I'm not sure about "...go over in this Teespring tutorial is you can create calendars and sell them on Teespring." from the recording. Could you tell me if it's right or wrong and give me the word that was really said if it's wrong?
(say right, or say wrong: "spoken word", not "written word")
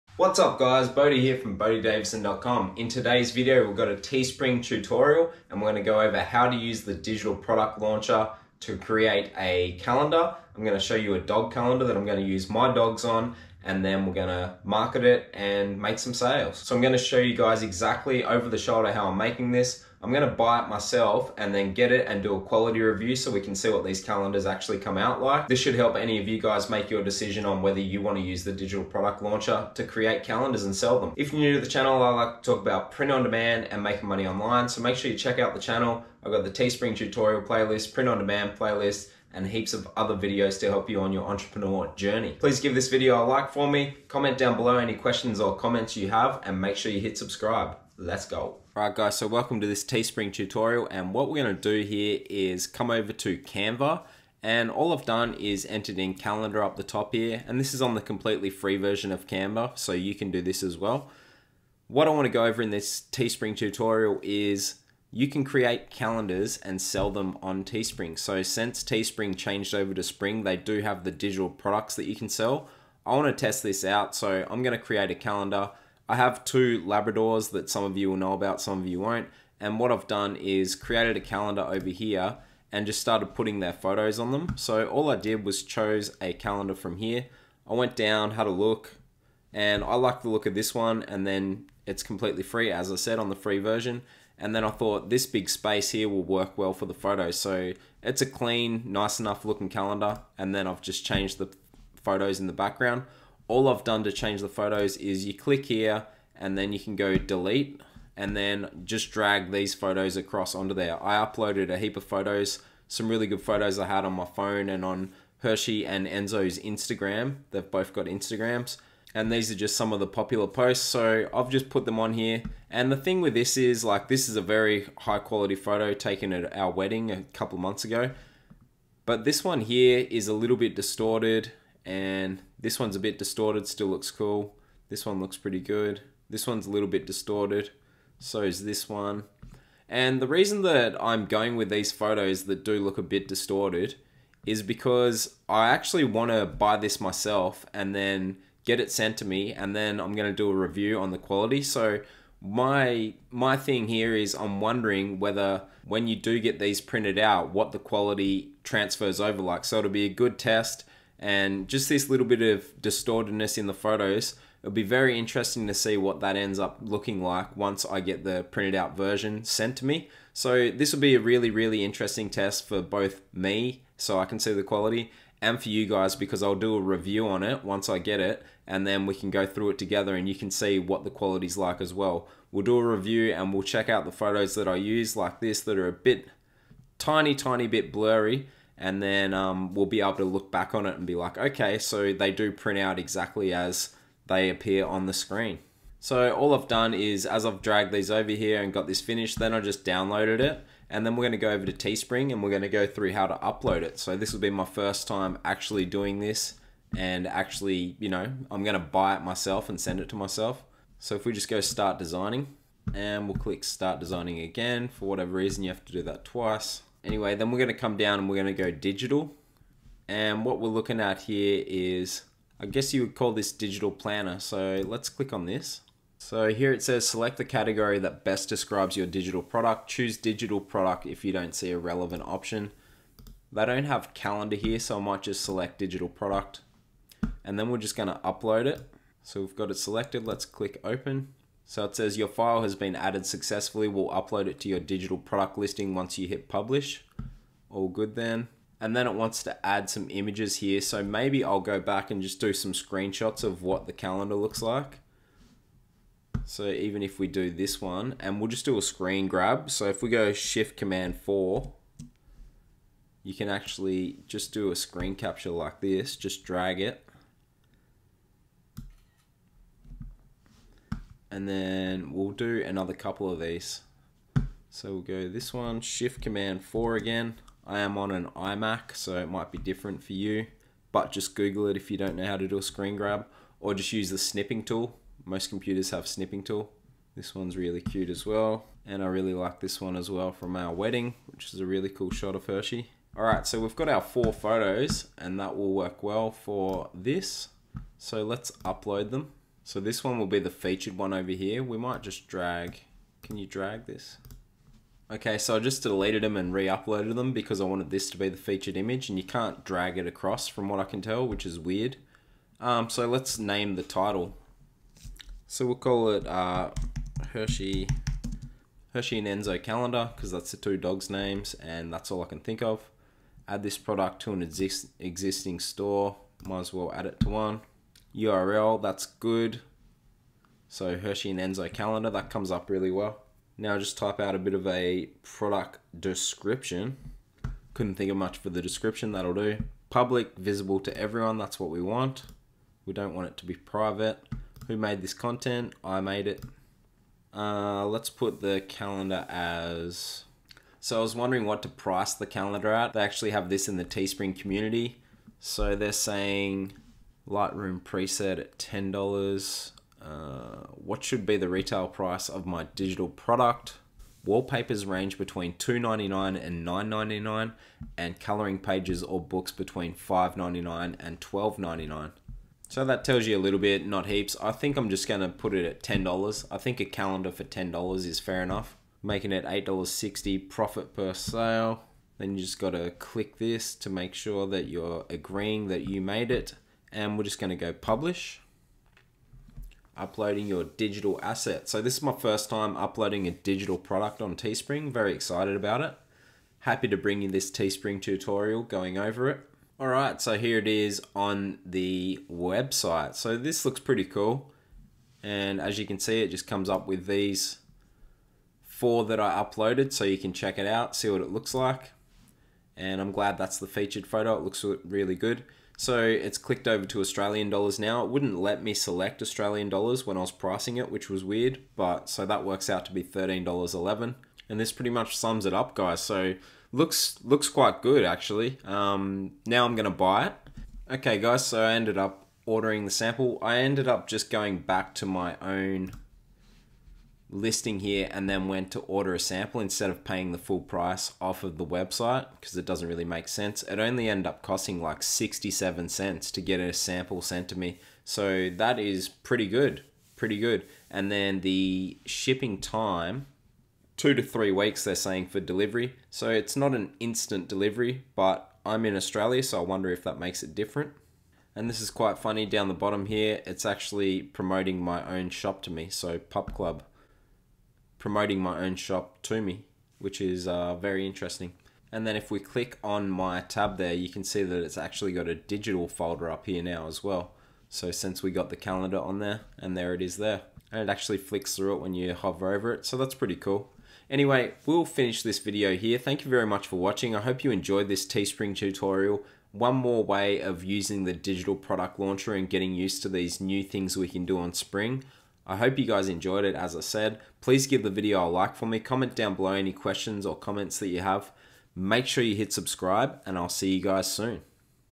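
right.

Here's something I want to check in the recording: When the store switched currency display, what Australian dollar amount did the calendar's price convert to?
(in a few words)
$13.11.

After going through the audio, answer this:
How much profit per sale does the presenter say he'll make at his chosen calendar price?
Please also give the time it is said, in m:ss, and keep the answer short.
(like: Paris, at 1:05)
$8.60, at 6:19.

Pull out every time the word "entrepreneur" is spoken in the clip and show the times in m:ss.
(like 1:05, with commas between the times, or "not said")
0:41.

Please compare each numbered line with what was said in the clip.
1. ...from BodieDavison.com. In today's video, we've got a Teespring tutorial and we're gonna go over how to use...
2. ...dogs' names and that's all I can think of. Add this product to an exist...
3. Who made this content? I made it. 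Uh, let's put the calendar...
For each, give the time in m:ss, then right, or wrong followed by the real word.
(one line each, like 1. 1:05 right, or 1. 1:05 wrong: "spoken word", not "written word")
1. 0:01 right
2. 5:20 right
3. 5:44 right.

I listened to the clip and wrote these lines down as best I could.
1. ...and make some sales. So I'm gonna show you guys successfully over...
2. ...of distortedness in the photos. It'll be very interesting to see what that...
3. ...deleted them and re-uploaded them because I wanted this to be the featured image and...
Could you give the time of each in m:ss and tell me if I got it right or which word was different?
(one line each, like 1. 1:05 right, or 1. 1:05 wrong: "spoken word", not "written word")
1. 0:15 wrong: "exactly", not "successfully"
2. 2:42 right
3. 5:05 right.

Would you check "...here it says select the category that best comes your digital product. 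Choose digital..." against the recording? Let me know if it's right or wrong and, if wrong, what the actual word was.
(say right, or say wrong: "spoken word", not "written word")
wrong: "describes", not "comes".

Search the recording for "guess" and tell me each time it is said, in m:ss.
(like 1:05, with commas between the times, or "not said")
3:42.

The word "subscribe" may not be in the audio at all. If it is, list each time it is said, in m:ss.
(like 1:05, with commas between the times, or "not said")
0:47, 8:22.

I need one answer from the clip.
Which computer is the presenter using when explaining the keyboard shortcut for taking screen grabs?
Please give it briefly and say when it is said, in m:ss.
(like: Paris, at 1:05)
iMac, at 4:38.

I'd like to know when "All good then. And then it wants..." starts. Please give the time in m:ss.
4:07.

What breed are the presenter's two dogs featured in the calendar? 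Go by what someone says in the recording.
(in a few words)
Labradors.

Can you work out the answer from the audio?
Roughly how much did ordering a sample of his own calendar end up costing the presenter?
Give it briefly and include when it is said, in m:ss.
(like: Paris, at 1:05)
67 cents, at 7:25.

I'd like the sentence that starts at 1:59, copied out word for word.
And these are just some of the popular posts.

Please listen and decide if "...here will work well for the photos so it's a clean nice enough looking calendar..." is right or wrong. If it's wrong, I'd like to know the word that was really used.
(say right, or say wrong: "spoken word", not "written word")
right.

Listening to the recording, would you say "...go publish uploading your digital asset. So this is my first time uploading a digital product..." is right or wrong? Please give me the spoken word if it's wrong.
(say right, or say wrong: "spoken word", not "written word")
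right.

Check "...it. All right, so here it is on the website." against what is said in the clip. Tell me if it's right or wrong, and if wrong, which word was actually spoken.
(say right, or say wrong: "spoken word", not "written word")
right.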